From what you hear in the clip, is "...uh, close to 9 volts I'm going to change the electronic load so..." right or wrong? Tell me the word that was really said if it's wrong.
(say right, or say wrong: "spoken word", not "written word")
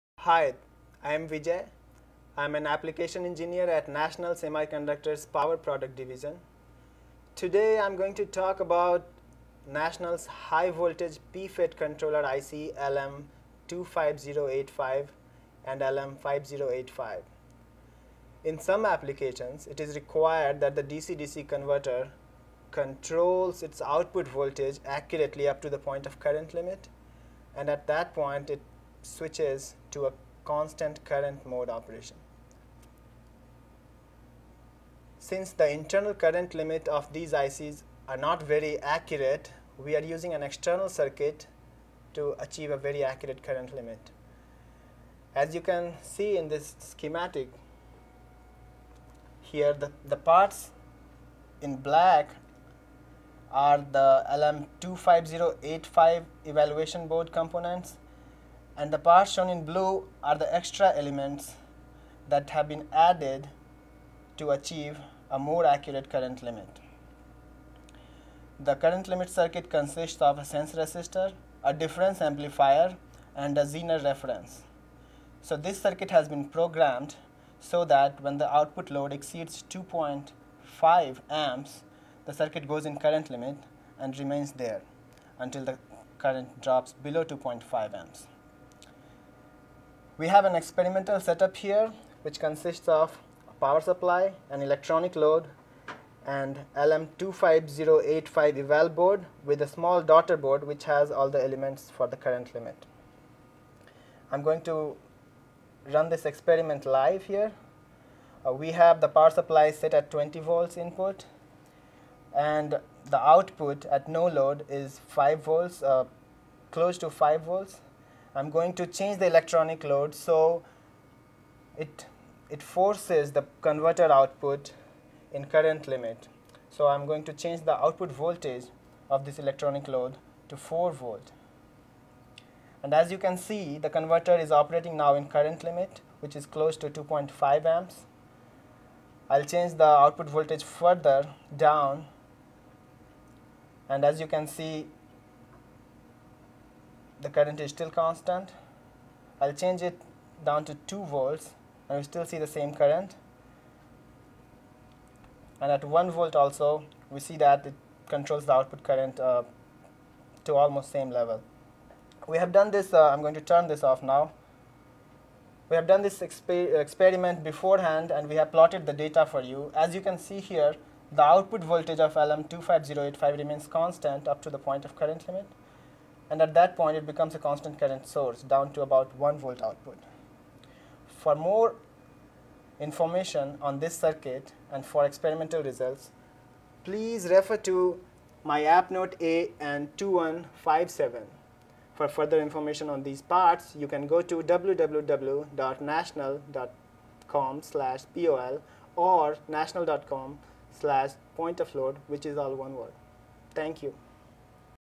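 wrong: "5", not "9".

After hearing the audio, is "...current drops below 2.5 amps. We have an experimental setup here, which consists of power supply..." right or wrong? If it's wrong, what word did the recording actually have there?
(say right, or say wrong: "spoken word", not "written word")
right.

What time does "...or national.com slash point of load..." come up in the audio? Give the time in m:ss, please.
3:18.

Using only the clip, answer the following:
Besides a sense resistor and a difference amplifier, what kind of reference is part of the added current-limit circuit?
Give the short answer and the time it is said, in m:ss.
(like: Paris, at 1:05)
Zener reference, at 1:13.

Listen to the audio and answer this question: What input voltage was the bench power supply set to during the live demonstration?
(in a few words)
20 volts.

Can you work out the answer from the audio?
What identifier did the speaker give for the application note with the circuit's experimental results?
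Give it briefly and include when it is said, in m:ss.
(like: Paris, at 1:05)
AN-2157, at 3:09.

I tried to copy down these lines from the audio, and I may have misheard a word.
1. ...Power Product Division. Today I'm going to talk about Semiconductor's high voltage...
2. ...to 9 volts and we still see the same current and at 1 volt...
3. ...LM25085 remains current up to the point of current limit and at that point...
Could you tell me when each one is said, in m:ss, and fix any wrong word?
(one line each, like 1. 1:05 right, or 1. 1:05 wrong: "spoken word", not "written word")
1. 0:05 wrong: "National", not "Semiconductor"
2. 2:30 wrong: "2", not "9"
3. 2:52 wrong: "constant", not "current".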